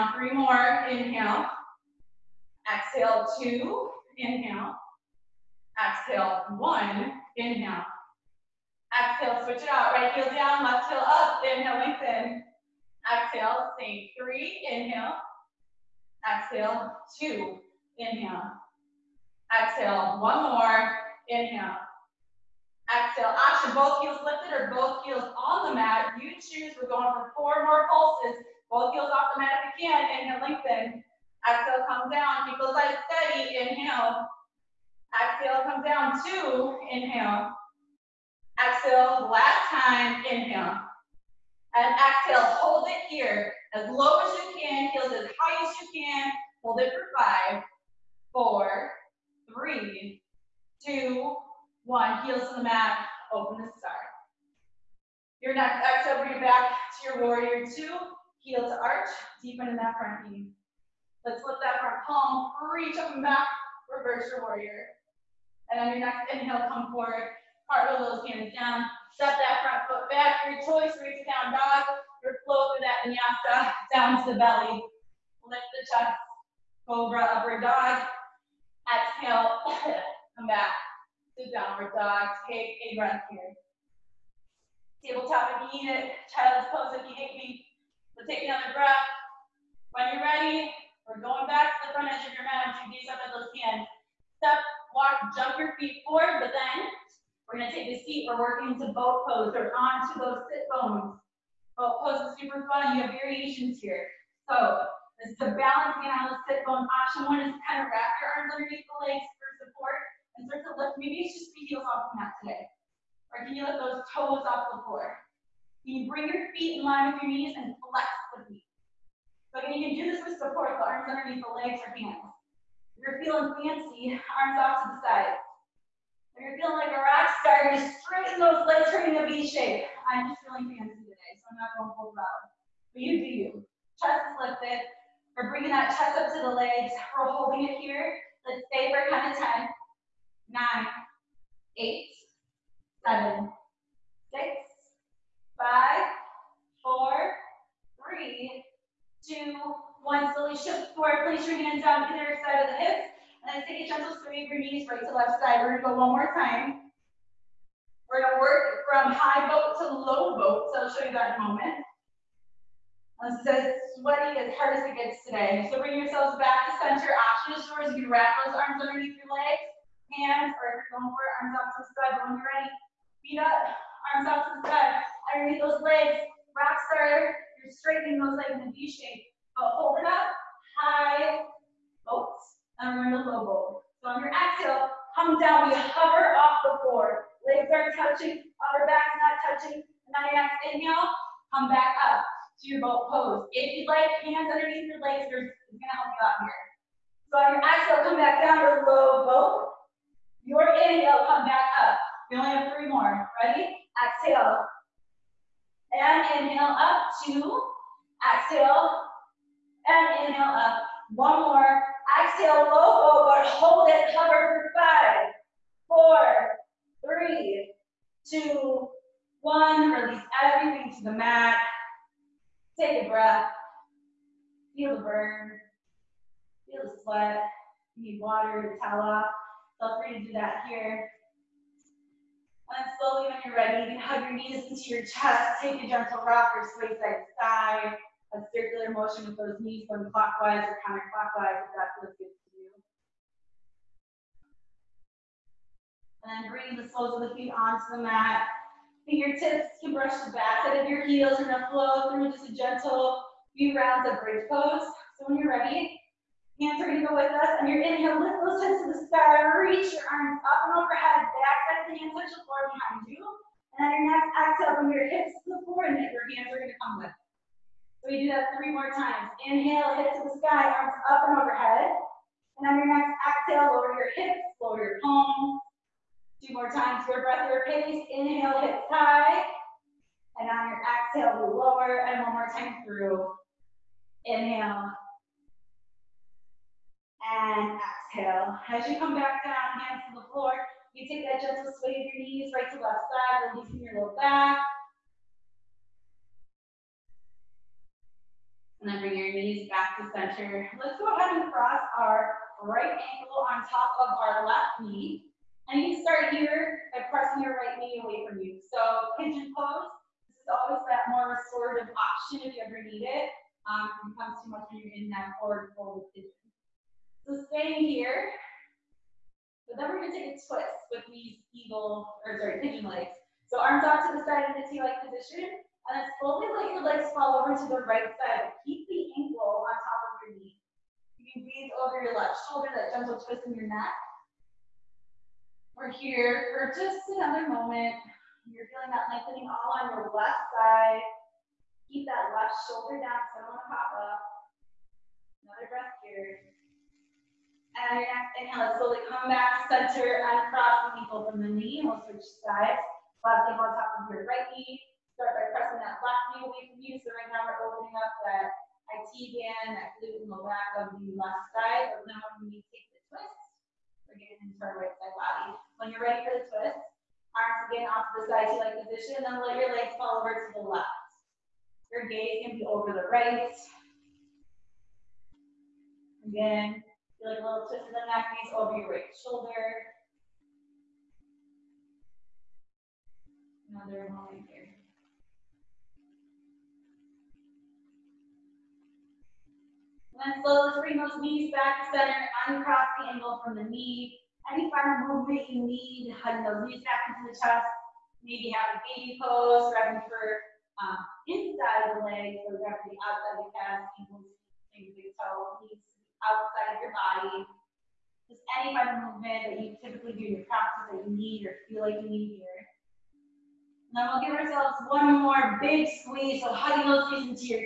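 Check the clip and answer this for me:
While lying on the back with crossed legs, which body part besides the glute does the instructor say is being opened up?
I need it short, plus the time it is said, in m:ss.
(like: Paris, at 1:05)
IT band, at 5:58.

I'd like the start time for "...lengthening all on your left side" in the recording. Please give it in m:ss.
5:39.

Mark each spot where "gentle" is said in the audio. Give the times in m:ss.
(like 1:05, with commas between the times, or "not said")
2:33, 3:55, 4:12, 4:51, 5:32.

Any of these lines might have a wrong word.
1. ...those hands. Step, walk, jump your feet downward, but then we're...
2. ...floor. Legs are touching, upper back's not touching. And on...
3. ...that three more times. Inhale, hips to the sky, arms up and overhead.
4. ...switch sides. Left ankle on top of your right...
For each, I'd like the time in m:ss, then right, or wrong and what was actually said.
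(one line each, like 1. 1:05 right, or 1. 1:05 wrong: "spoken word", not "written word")
1. 1:33 wrong: "forward", not "downward"
2. 3:06 right
3. 4:28 right
4. 5:52 right.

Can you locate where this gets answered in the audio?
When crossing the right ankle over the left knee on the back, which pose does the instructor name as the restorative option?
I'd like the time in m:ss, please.
5:09.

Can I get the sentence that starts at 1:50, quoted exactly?
Maybe it's just the heels off the mat today.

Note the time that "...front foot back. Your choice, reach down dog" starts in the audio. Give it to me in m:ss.
1:09.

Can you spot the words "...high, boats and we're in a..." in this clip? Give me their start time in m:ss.
3:00.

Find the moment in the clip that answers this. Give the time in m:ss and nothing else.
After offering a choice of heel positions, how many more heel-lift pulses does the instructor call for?
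0:27.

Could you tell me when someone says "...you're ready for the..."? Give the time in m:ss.
6:05.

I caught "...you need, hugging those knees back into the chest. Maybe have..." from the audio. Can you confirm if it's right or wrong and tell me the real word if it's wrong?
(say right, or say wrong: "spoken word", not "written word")
right.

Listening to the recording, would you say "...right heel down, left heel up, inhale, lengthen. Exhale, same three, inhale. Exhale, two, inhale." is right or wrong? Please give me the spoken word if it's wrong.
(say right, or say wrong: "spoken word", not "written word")
right.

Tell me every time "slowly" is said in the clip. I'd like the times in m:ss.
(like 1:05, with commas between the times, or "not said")
2:30, 3:52, 5:26, 5:48, 6:30.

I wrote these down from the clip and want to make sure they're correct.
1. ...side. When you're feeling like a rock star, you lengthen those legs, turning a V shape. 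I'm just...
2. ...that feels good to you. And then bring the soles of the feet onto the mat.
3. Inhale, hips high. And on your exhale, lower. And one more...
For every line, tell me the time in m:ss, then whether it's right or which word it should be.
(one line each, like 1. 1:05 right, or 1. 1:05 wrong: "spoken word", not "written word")
1. 2:05 wrong: "straighten", not "lengthen"
2. 4:01 right
3. 4:38 right.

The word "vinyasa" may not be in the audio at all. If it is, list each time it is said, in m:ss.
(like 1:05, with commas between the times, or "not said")
1:13.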